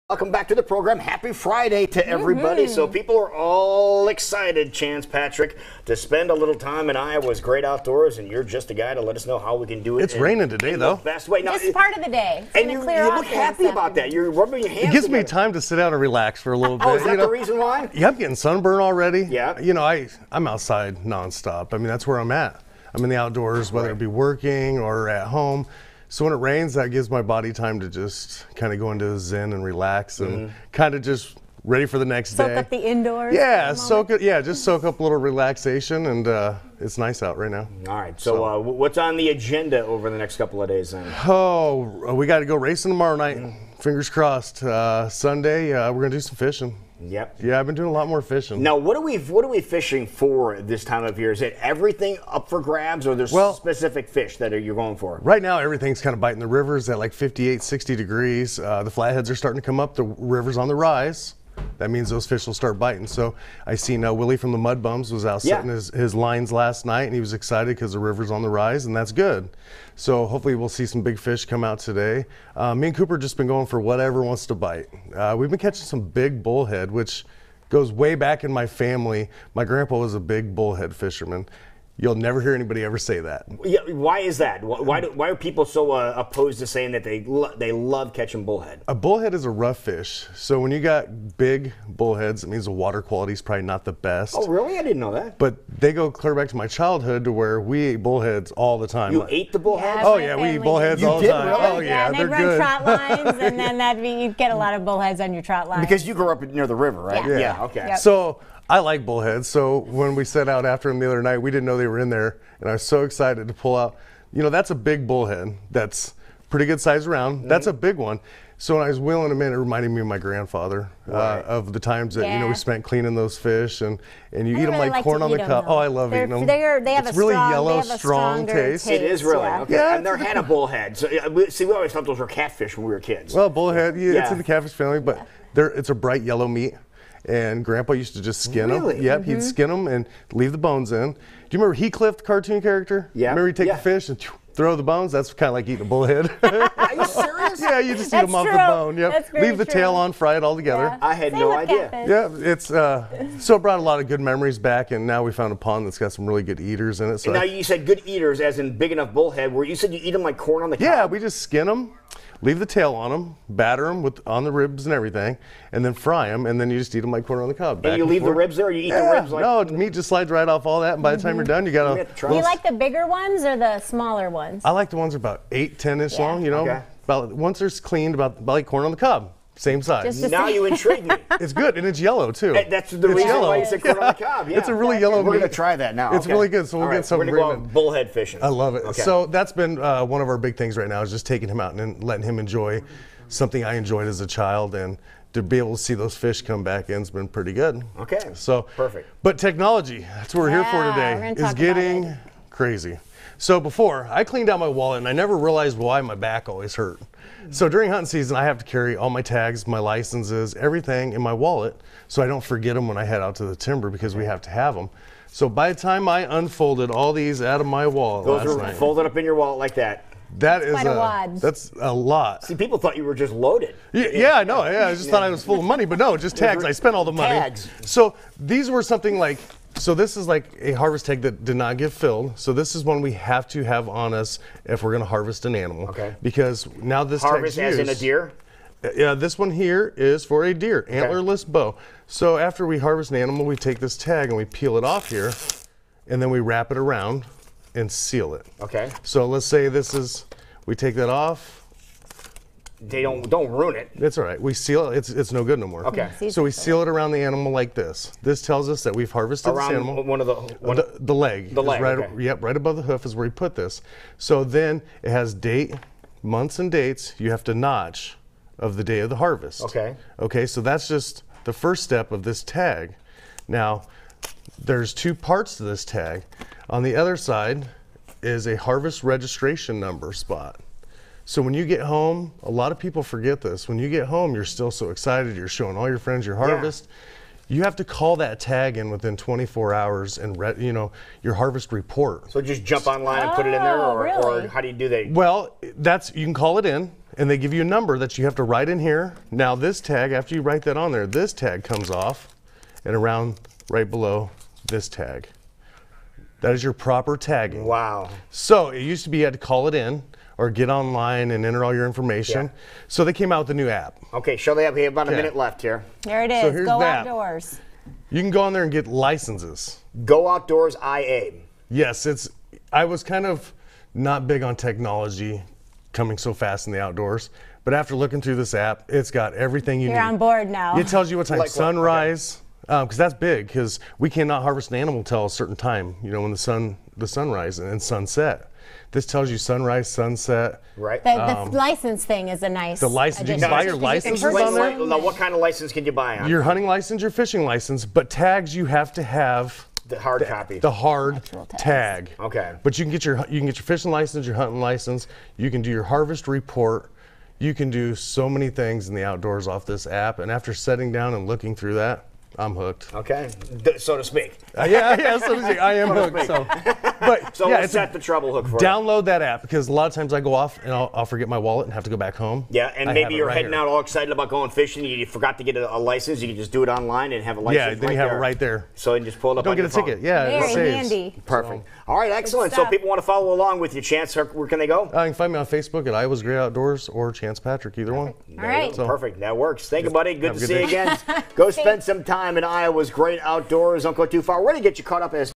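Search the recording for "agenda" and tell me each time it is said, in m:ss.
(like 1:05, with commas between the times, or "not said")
0:39.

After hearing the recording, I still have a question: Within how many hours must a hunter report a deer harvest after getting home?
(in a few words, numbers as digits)
24 hours.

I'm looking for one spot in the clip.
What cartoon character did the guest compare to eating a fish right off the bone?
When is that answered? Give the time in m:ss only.
2:21.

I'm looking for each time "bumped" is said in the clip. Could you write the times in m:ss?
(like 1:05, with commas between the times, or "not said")
not said.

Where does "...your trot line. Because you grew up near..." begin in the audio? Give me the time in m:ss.
1:45.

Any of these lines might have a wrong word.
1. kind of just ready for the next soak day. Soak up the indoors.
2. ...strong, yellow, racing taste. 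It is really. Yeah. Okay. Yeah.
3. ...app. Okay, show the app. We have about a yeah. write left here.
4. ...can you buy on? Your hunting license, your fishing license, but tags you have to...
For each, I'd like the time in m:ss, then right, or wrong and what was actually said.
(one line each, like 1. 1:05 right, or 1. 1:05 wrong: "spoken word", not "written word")
1. 0:30 right
2. 2:07 wrong: "strong", not "racing"
3. 5:13 wrong: "minute", not "write"
4. 5:45 right.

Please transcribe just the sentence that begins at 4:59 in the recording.
Now this tag, after you write that on there, this tag comes off, and around right below this tag.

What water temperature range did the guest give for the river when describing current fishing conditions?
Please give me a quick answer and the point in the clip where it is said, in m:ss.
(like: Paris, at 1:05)
58 to 60 degrees, at 0:57.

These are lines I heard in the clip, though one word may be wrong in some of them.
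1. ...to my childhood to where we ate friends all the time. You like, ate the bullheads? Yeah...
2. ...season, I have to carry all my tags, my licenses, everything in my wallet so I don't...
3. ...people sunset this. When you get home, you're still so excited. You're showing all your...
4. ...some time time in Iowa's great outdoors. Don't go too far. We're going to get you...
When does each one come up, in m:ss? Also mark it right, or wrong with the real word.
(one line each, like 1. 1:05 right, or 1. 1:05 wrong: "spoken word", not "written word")
1. 1:36 wrong: "bullheads", not "friends"
2. 3:28 right
3. 4:42 wrong: "forget", not "sunset"
4. 6:31 right.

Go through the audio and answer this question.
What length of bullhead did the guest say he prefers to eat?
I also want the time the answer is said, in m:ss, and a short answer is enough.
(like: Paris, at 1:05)
8 to 10 inches, at 2:55.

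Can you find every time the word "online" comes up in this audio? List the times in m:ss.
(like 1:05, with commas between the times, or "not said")
4:52, 5:10, 6:16.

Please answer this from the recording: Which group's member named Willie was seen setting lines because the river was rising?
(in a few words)
Mud Bums.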